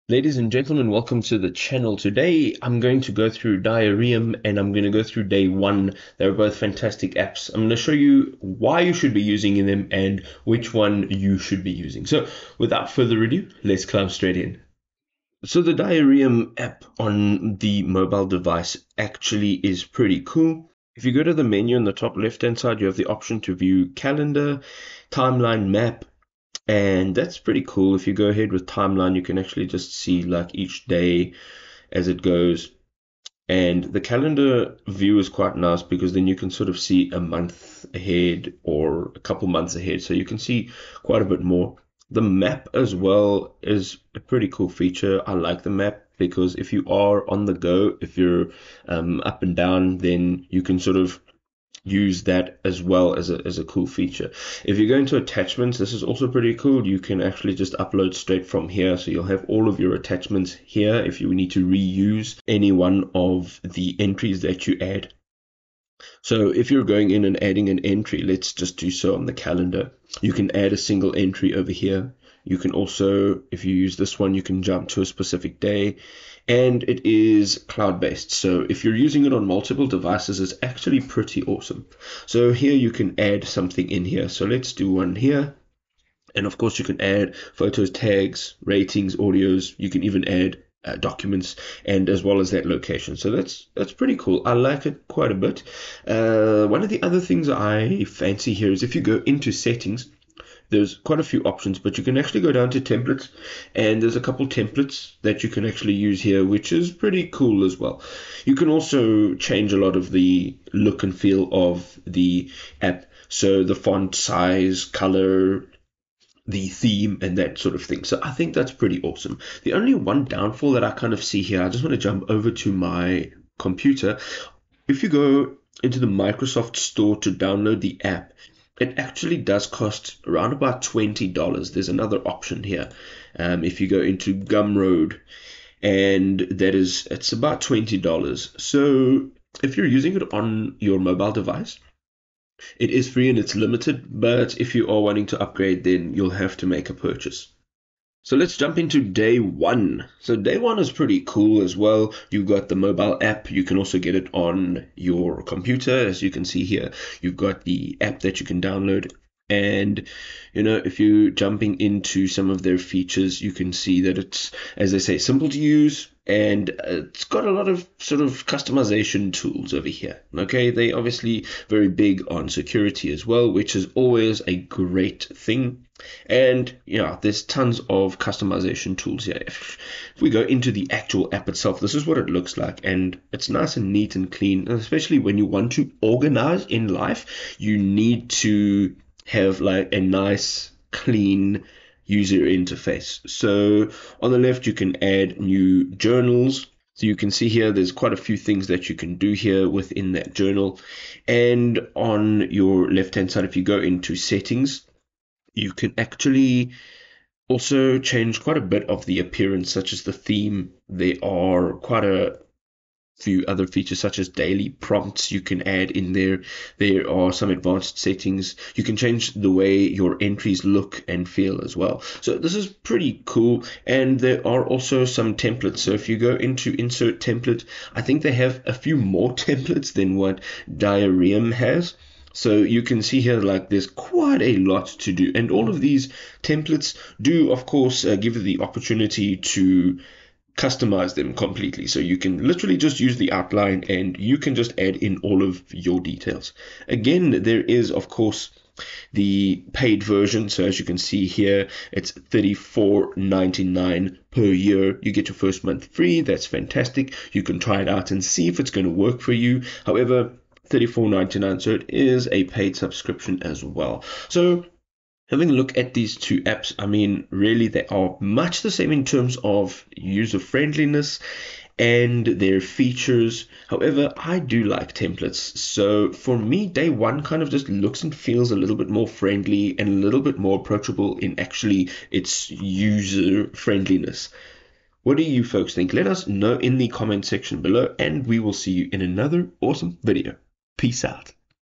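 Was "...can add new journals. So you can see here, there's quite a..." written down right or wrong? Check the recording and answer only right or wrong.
right.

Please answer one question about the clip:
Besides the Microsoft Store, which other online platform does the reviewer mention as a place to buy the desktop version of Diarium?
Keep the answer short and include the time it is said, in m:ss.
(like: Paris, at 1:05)
Gumroad, at 2:14.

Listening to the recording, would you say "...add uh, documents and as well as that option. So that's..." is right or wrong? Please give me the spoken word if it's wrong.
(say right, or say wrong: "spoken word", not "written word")
wrong: "location", not "option".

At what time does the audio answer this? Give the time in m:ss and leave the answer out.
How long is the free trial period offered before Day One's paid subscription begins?
4:15.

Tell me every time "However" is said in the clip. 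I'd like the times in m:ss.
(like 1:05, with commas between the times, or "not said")
4:19, 4:33.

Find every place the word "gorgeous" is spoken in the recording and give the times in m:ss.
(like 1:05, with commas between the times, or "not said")
not said.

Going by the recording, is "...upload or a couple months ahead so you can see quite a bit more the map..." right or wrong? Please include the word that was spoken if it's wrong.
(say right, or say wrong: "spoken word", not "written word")
wrong: "ahead", not "upload".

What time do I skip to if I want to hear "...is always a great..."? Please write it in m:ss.
2:53.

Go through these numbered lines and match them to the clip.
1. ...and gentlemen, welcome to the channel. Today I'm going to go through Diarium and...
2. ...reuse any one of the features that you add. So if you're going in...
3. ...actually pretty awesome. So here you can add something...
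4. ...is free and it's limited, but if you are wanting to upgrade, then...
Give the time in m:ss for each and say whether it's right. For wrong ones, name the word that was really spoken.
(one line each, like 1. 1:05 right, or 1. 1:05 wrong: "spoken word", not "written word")
1. 0:00 right
2. 1:01 wrong: "entries", not "features"
3. 1:20 right
4. 2:22 right.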